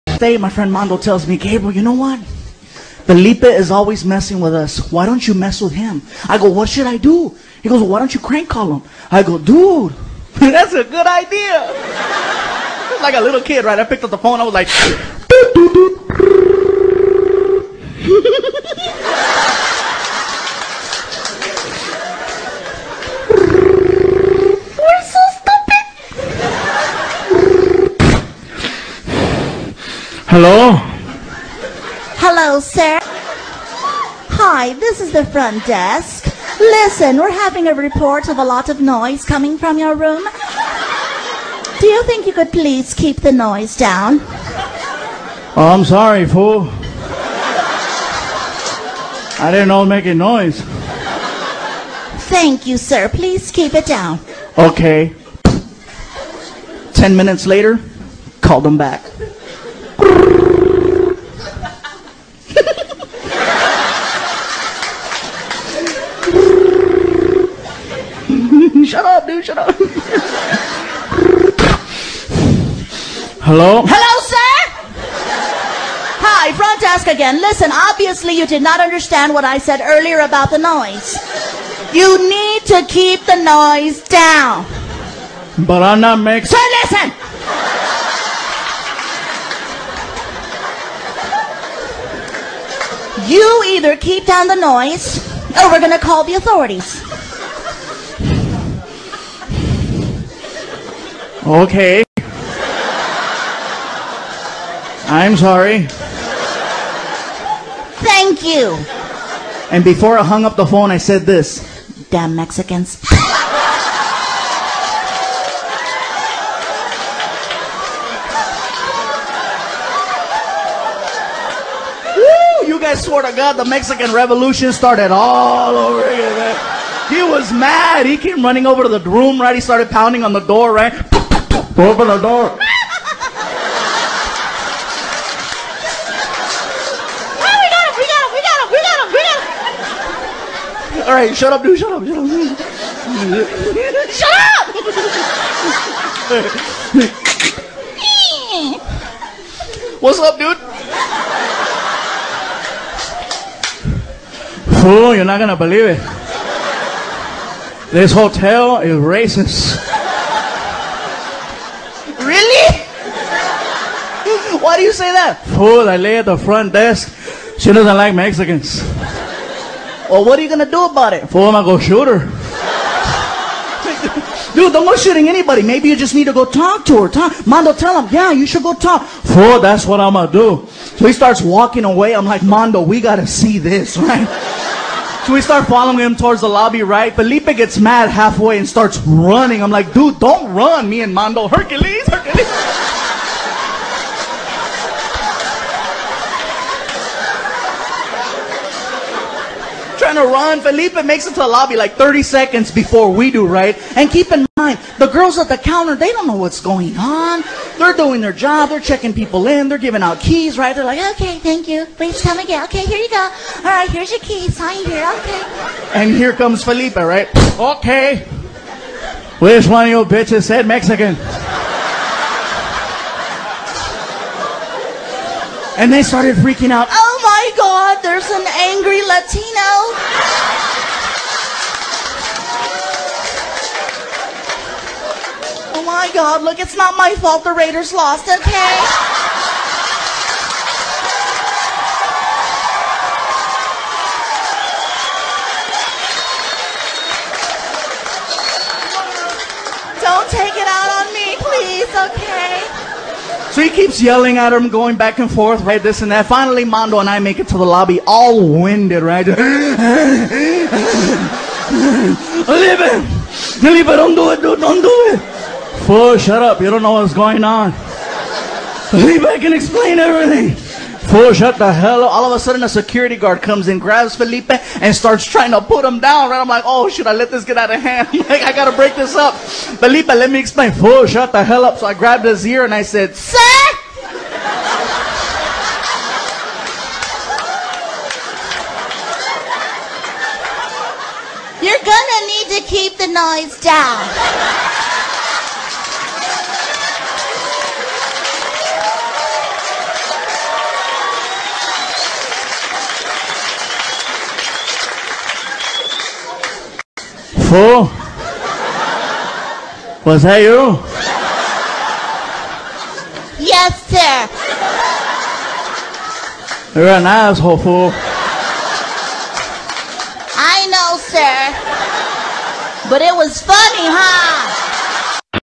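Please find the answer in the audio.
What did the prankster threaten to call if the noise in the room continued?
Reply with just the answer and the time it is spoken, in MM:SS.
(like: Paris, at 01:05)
the authorities, at 01:36.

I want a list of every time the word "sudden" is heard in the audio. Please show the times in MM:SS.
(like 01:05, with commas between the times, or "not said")
04:32.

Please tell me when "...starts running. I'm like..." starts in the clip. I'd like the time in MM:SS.
03:08.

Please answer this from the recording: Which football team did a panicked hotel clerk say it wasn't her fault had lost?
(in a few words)
Raiders.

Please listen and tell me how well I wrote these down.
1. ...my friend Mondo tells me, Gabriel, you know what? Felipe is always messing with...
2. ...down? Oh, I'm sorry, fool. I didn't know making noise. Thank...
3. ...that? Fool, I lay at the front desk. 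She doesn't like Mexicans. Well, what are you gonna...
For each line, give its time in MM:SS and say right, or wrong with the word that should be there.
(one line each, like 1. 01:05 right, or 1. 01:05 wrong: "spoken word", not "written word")
1. 00:00 right
2. 00:43 right
3. 02:45 right.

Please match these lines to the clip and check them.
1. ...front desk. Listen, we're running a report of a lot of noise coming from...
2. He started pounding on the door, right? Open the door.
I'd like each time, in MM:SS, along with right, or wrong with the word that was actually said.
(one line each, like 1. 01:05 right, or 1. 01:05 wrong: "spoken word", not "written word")
1. 00:35 wrong: "having", not "running"
2. 02:09 right.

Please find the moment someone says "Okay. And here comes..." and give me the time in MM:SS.
03:35.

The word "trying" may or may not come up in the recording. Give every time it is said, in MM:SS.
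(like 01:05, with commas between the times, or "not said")
04:35.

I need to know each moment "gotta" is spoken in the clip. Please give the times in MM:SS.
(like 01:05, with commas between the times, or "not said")
03:02, 04:38.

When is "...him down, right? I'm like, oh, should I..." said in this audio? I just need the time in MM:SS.
04:35.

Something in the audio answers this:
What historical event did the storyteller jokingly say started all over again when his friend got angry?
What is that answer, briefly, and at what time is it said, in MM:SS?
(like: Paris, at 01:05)
Mexican Revolution, at 02:03.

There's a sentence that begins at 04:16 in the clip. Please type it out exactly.
Finally, Mondo and I make it to the lobby, all winded, right?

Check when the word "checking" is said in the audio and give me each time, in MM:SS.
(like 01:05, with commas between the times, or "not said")
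03:28.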